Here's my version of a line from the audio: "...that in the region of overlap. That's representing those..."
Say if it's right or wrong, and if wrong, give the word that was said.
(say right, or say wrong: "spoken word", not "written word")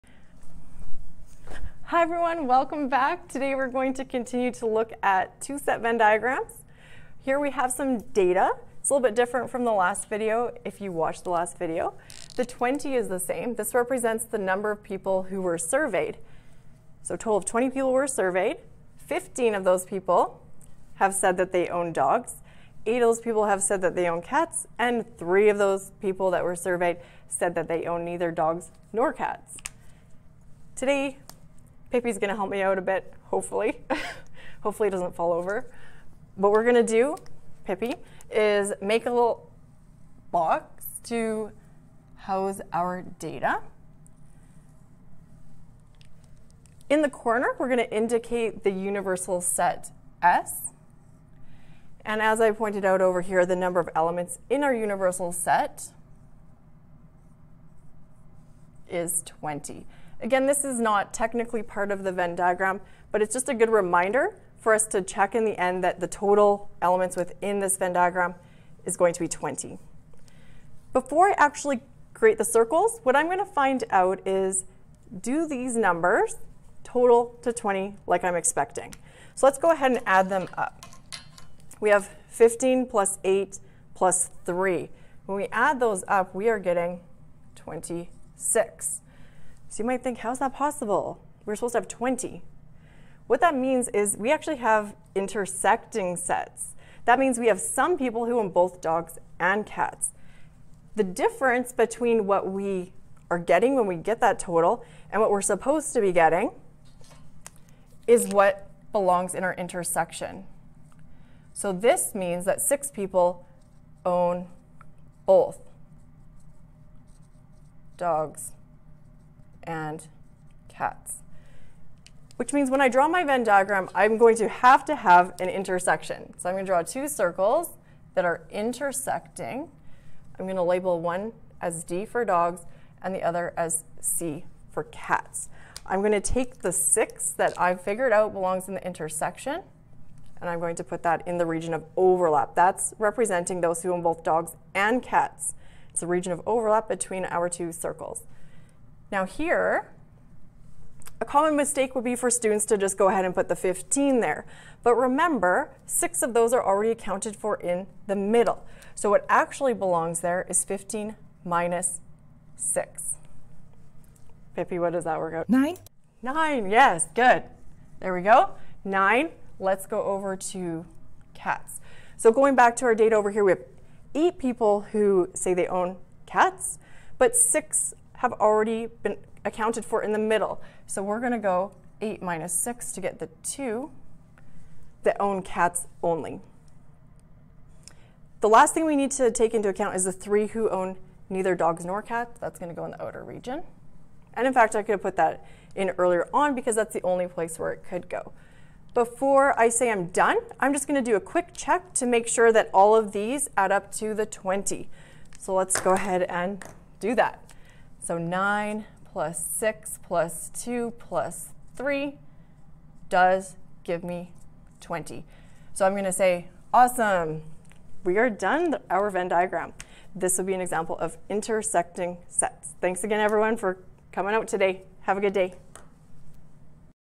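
right.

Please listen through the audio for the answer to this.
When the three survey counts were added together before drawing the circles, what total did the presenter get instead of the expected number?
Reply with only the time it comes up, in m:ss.
1:27.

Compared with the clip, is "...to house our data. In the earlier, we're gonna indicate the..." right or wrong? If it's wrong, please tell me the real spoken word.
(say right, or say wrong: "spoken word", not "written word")
wrong: "corner", not "earlier".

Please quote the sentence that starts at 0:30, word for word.
Today, Pippi's gonna help me out a bit, hopefully.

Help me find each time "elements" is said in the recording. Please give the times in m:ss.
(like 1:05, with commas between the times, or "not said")
0:53, 1:06.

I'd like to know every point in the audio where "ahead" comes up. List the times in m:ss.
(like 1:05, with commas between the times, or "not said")
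1:19, 2:33, 3:25.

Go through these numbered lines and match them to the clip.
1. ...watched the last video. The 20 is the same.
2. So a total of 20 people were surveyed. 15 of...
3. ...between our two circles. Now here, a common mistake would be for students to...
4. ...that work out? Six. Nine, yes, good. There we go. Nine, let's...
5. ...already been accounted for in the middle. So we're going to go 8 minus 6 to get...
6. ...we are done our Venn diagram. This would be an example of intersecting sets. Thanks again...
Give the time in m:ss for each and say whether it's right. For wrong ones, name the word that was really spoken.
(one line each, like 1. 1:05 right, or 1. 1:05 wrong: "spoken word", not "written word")
1. 0:10 right
2. 0:17 right
3. 2:26 right
4. 2:45 wrong: "Nine", not "Six"
5. 2:58 right
6. 3:38 right.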